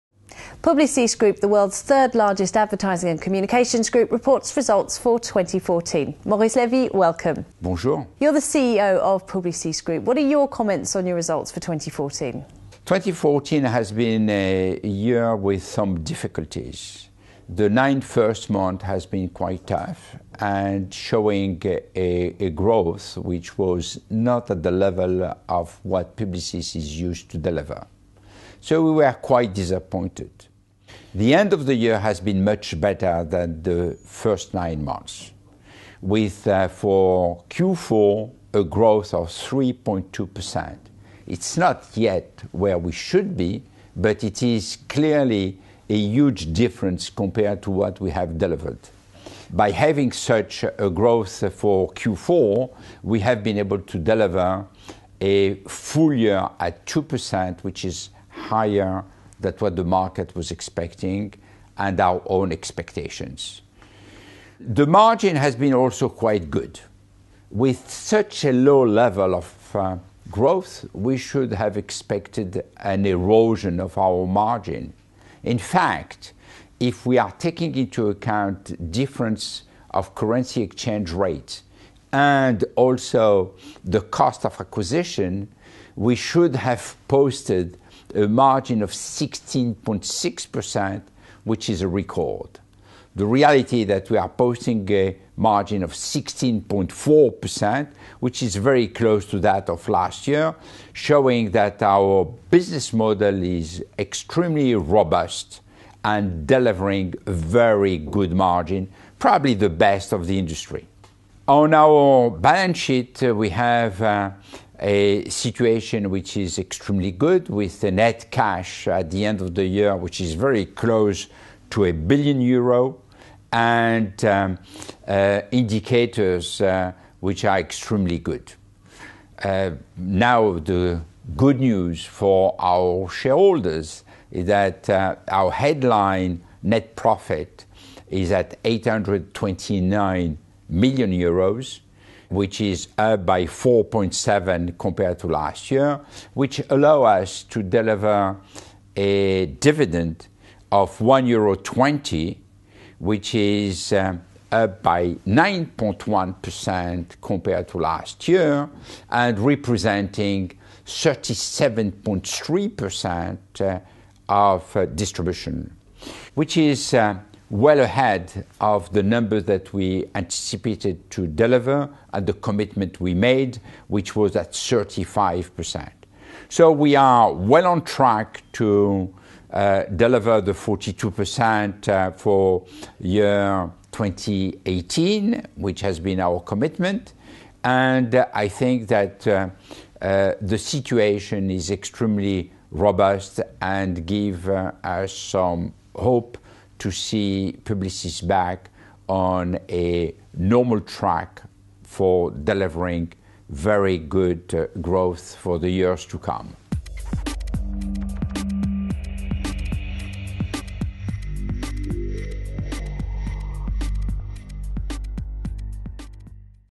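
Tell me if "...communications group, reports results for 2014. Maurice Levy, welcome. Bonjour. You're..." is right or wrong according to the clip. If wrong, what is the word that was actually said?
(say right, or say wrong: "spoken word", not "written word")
right.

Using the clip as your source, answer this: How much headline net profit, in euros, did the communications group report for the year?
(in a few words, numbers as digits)
829 million euros.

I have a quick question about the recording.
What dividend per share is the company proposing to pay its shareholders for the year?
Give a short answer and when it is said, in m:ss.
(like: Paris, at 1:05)
1.20 euro, at 2:30.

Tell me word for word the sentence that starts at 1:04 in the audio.
The margin has been also quite good.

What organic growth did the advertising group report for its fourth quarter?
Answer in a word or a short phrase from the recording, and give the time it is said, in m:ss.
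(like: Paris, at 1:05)
3.2%, at 0:39.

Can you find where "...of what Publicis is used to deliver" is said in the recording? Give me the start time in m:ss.
0:25.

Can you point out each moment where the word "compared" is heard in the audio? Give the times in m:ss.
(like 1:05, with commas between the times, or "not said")
0:47, 2:24, 2:37.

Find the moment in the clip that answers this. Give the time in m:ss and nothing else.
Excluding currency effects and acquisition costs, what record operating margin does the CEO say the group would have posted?
1:28.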